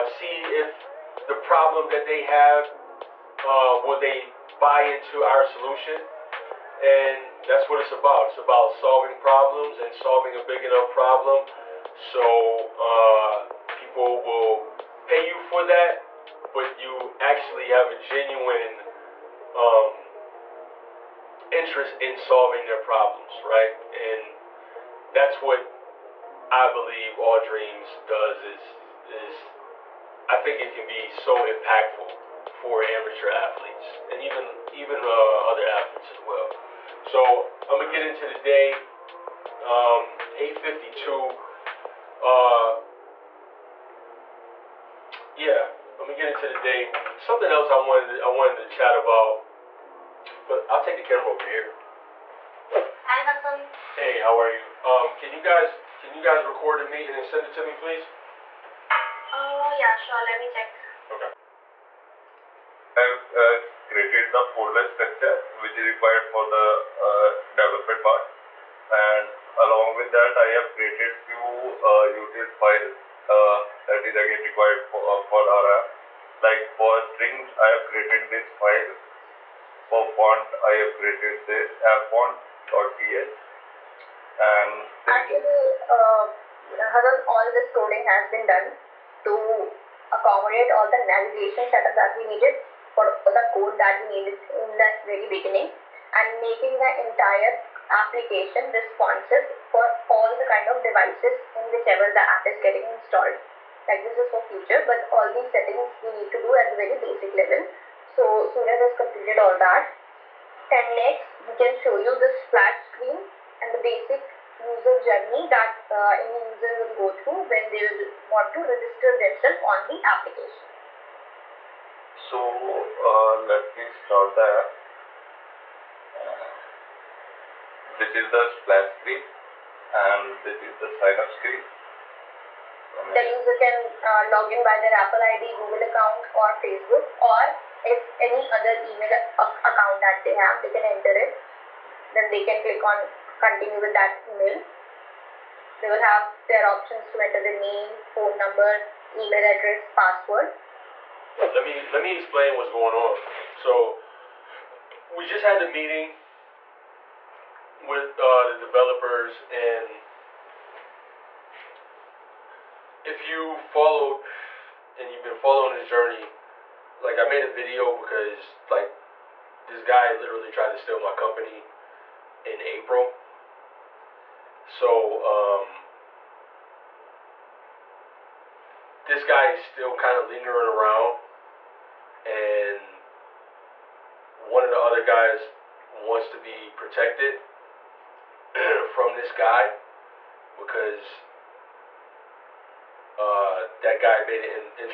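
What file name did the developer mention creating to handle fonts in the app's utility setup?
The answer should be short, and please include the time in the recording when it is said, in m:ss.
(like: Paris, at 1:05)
appfont.ts, at 1:21.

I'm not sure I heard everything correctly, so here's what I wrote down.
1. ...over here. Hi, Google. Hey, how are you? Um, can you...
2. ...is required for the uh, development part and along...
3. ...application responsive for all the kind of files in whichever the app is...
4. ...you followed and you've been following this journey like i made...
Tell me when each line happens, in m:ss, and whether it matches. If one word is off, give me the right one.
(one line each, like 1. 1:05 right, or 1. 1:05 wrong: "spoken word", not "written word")
1. 0:51 wrong: "Hassan", not "Google"
2. 1:05 right
3. 1:37 wrong: "devices", not "files"
4. 2:43 right.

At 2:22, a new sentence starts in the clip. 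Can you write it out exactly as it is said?
Then they can click on continue with that email.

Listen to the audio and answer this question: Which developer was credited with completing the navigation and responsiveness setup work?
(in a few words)
Suraj.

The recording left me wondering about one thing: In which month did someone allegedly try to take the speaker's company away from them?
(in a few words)
April.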